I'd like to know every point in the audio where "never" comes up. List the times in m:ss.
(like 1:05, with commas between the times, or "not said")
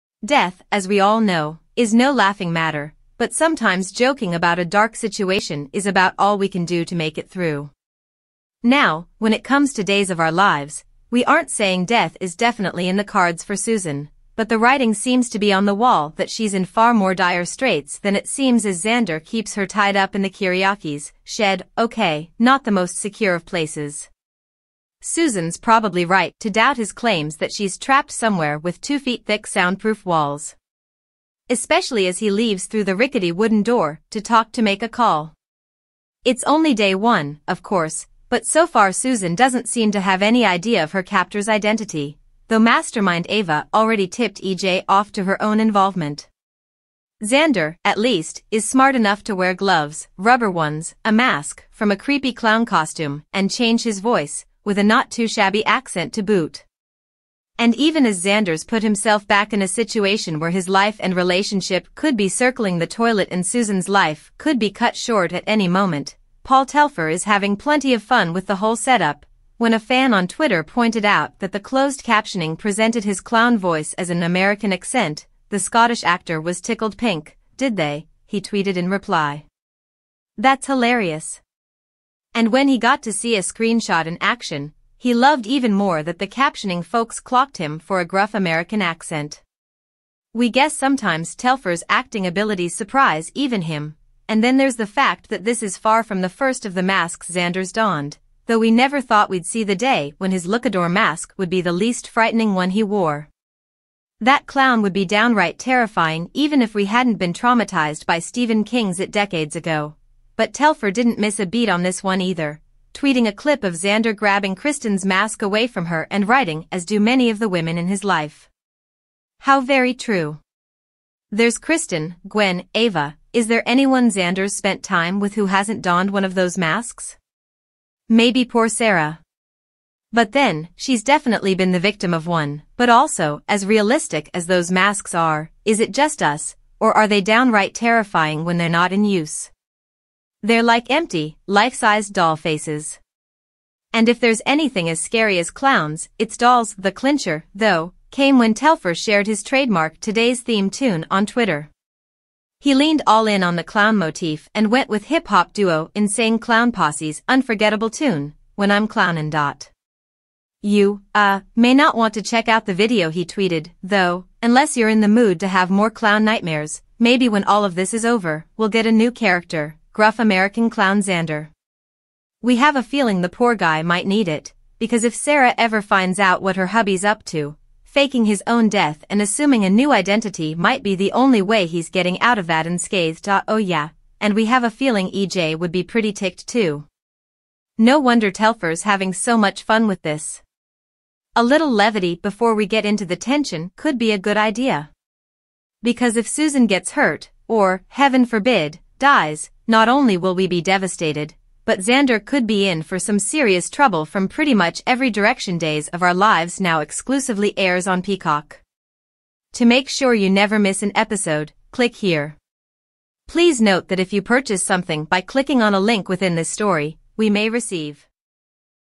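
1:38, 3:30.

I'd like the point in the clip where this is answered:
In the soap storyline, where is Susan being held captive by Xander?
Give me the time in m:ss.
0:20.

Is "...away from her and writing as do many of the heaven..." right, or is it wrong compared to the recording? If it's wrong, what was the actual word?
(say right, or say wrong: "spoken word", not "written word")
wrong: "women", not "heaven".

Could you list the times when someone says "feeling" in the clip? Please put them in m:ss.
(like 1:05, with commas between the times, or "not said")
2:52, 3:04.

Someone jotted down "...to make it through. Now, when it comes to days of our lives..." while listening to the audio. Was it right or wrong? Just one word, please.
right.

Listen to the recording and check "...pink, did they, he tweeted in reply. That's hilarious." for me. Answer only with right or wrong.
right.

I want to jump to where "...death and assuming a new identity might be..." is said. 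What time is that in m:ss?
2:58.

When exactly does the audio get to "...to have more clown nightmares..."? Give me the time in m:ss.
2:45.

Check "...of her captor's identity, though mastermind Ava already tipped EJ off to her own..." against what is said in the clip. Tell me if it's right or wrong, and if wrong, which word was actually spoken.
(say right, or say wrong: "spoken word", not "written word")
right.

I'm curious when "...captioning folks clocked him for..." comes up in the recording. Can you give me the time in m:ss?
1:26.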